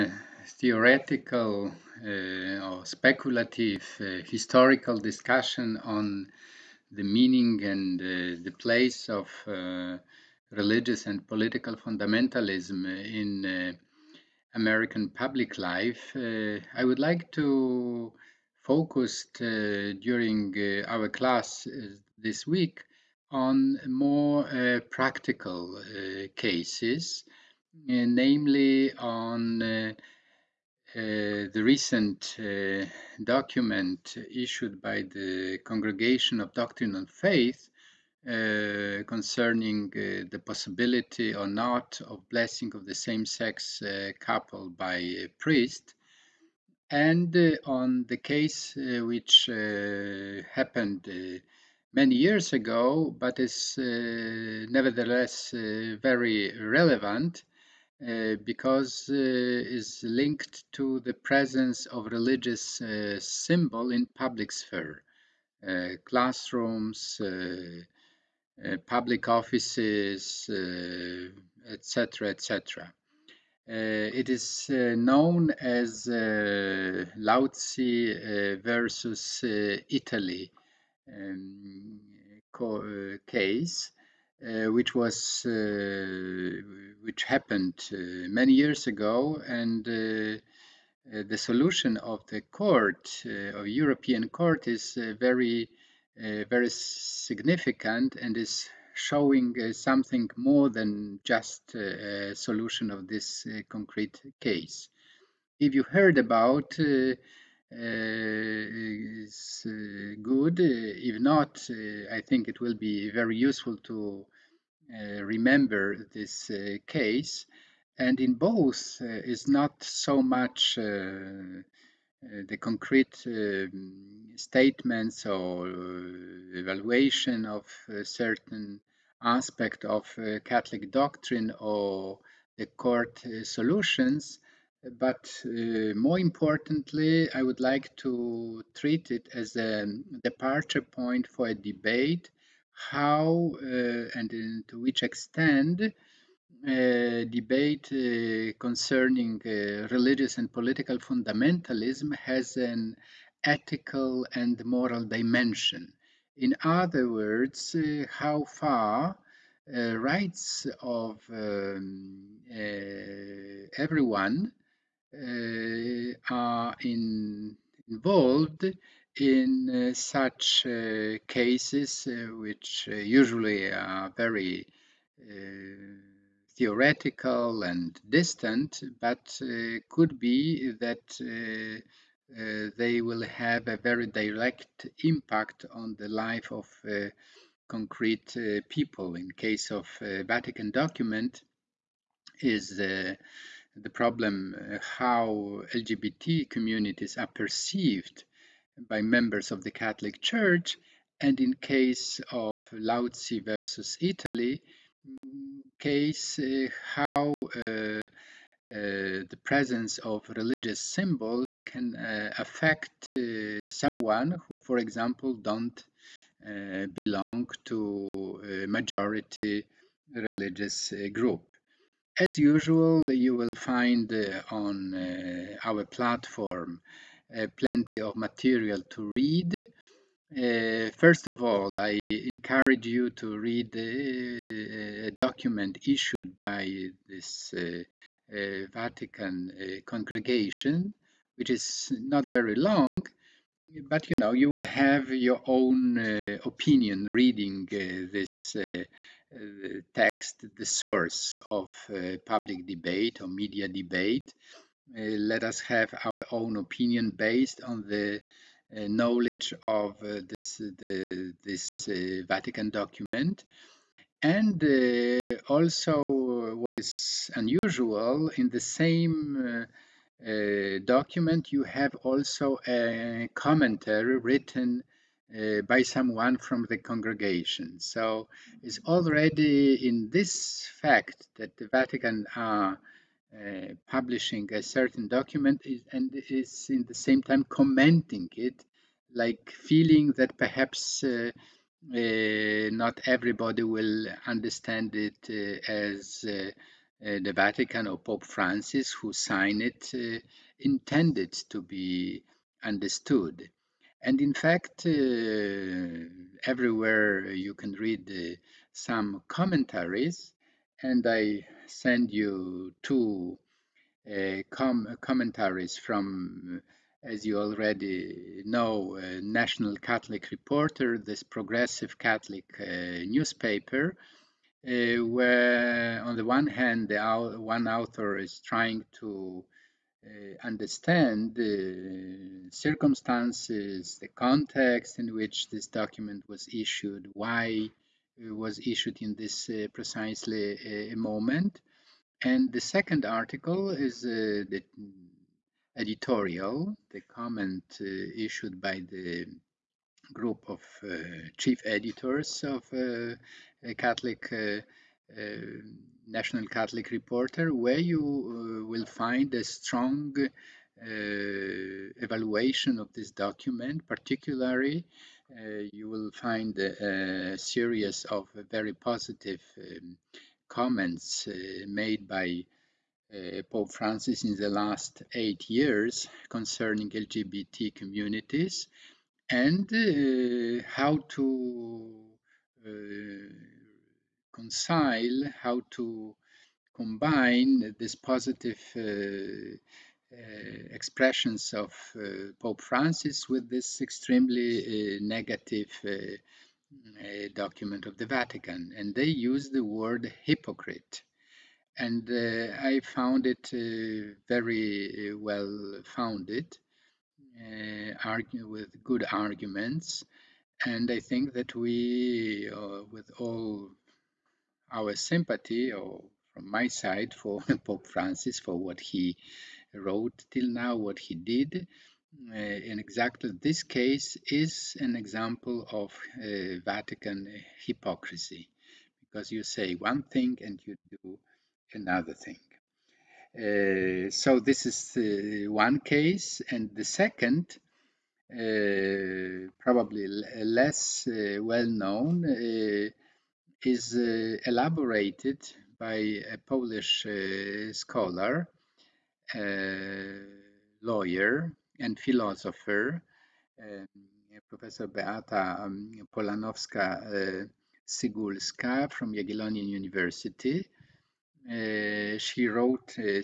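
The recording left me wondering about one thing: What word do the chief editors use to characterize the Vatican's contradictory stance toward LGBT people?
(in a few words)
hypocrite.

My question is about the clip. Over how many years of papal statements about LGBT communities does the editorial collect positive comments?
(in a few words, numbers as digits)
8.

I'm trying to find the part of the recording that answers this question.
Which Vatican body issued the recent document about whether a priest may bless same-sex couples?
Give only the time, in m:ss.
0:35.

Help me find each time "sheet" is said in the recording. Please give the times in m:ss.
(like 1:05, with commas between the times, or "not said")
not said.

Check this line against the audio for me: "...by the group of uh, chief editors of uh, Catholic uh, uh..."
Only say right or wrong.
right.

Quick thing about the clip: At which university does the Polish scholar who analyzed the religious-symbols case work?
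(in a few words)
Jagiellonian University.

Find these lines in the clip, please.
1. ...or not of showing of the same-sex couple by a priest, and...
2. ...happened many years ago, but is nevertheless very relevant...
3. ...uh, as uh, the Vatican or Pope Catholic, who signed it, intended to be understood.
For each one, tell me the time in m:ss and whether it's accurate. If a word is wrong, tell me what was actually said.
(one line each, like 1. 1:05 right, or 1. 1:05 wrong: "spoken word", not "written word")
1. 0:41 wrong: "blessing", not "showing"
2. 0:50 right
3. 4:55 wrong: "Francis", not "Catholic".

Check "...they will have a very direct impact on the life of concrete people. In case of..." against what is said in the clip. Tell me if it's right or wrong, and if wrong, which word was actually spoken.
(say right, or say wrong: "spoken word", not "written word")
right.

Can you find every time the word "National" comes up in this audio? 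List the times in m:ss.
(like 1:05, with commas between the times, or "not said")
5:19, 5:56.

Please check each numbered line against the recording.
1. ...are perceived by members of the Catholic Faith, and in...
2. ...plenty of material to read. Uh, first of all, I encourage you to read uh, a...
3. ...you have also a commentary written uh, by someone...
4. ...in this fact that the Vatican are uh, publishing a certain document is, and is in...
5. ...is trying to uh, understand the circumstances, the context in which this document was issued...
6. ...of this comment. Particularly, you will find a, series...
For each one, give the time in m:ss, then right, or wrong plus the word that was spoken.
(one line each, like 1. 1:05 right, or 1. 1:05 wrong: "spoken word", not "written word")
1. 3:17 wrong: "Church", not "Faith"
2. 3:47 right
3. 4:31 right
4. 4:39 right
5. 5:28 right
6. 6:02 wrong: "document", not "comment".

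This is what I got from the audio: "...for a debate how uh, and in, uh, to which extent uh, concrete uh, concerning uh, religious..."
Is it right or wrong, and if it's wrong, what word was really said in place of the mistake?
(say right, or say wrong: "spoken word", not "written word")
wrong: "debate", not "concrete".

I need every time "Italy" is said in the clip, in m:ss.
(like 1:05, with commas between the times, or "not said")
1:19, 3:23.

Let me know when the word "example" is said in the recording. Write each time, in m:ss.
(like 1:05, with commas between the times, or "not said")
3:34, 7:04.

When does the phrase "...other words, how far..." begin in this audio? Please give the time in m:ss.
2:36.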